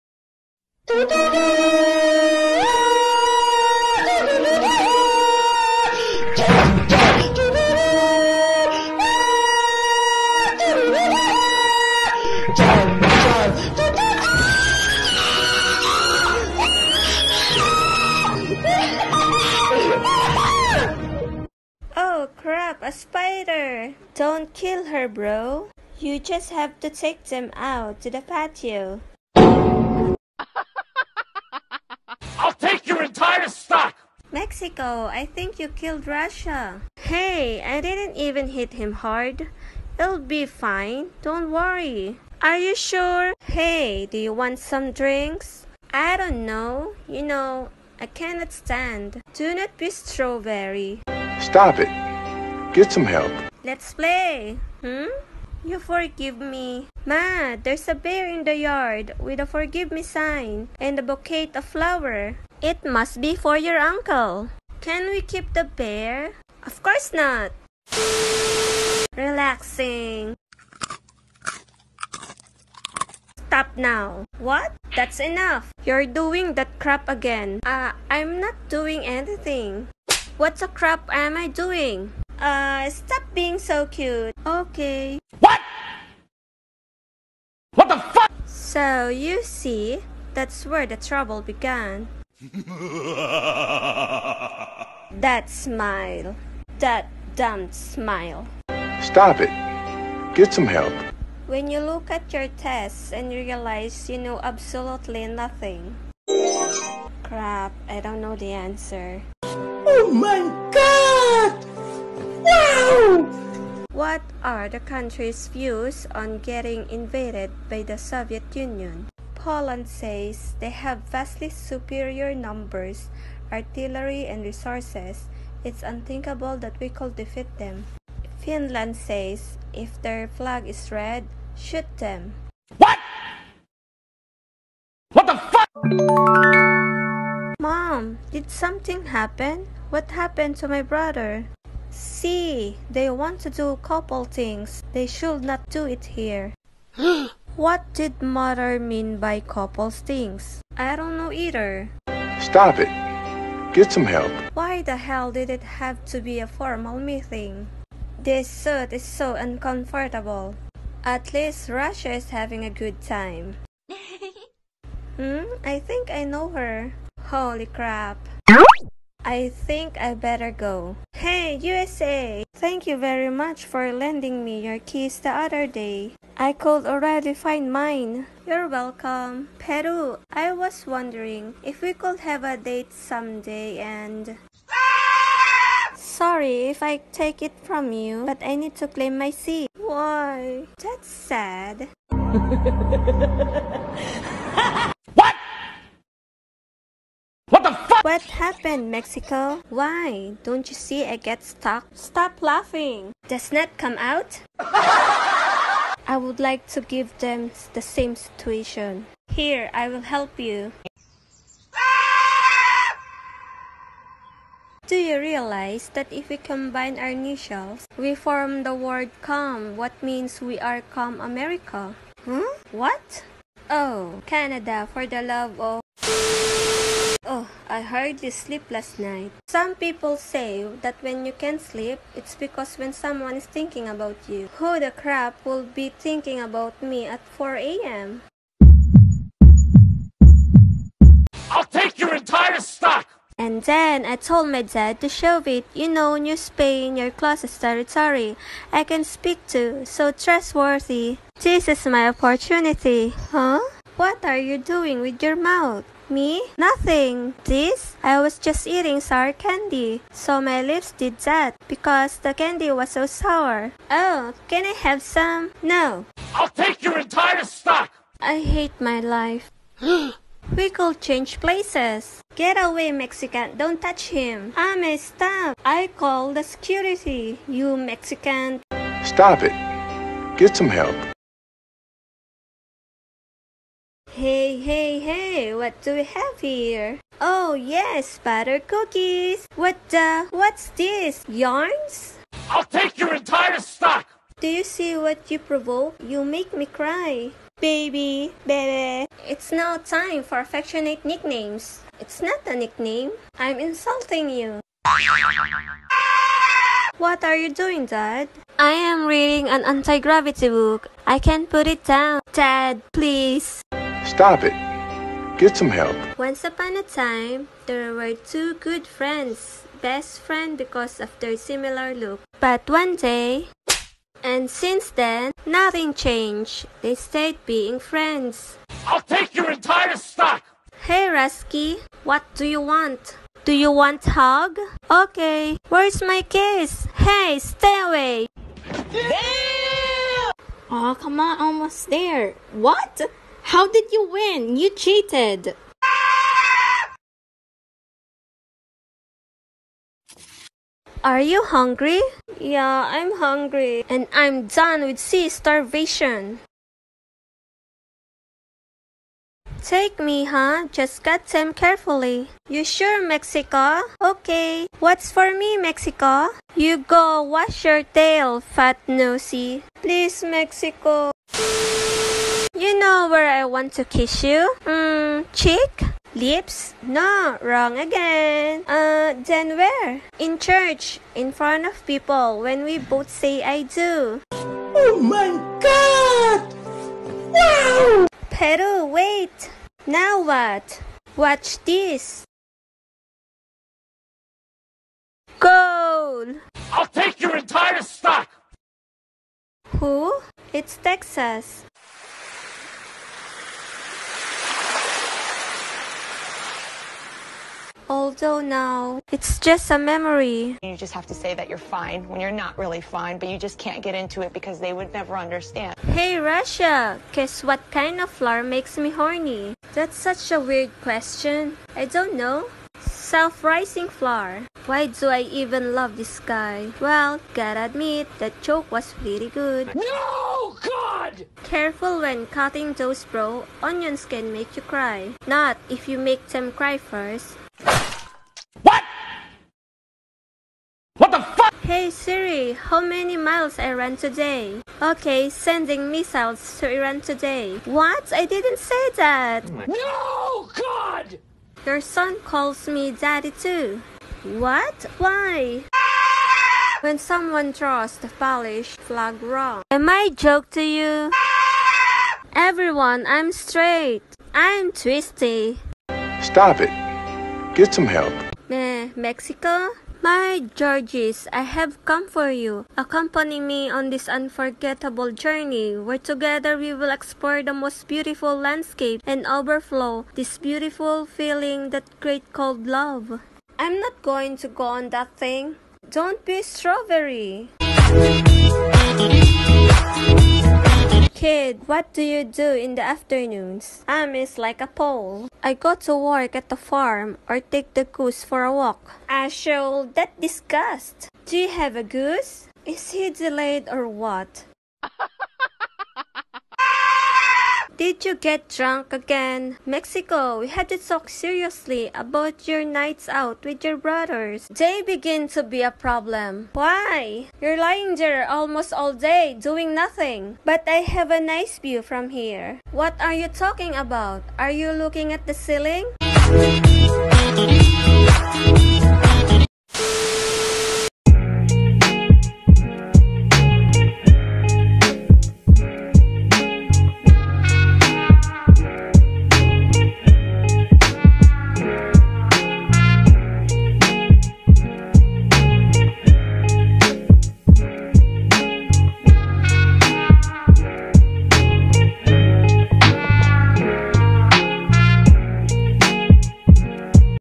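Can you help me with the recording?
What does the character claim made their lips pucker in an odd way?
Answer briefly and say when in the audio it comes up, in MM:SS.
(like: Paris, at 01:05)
Sour candy, at 04:18.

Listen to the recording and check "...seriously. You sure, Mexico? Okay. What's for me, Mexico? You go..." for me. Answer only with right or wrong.
wrong.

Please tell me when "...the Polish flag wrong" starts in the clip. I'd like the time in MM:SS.
07:37.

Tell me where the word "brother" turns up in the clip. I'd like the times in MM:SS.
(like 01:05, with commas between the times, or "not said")
02:20, 08:33.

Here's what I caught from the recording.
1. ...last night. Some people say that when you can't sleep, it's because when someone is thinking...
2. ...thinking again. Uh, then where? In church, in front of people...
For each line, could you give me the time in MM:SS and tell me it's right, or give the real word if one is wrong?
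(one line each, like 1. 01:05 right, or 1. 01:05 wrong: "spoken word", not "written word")
1. 03:48 right
2. 06:17 wrong: "wrong", not "thinking".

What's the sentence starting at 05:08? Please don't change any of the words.
I am reading an anti gravity book.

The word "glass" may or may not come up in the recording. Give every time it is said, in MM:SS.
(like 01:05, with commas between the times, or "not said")
not said.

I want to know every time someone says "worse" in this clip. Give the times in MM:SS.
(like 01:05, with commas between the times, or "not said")
not said.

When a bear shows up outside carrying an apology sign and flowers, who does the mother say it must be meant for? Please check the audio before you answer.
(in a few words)
Your uncle.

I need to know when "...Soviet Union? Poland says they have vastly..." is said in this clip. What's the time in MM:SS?
01:57.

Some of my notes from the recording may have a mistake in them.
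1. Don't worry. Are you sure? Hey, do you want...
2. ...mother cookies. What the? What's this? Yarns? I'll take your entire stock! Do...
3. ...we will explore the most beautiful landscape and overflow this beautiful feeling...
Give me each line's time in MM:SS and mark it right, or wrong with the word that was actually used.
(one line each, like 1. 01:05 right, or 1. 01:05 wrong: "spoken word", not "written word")
1. 00:41 right
2. 04:48 wrong: "butter", not "mother"
3. 07:56 right.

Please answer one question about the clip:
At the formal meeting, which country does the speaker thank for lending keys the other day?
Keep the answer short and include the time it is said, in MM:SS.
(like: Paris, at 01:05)
USA, at 02:51.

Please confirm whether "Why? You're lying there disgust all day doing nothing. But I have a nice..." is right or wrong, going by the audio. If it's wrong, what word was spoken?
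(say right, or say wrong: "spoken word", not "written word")
wrong: "almost", not "disgust".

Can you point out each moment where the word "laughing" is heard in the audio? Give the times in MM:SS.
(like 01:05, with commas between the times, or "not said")
03:22.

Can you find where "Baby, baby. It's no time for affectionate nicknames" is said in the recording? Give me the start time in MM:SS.
04:57.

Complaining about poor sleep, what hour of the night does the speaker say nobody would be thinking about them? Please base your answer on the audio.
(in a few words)
4 a.m.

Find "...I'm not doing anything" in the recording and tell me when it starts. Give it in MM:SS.
01:18.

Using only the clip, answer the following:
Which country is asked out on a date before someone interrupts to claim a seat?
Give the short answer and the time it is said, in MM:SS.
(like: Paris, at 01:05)
Peru, at 02:59.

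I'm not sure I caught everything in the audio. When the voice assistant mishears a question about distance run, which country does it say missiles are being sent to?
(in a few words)
Iran.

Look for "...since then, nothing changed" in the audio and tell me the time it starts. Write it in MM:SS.
05:24.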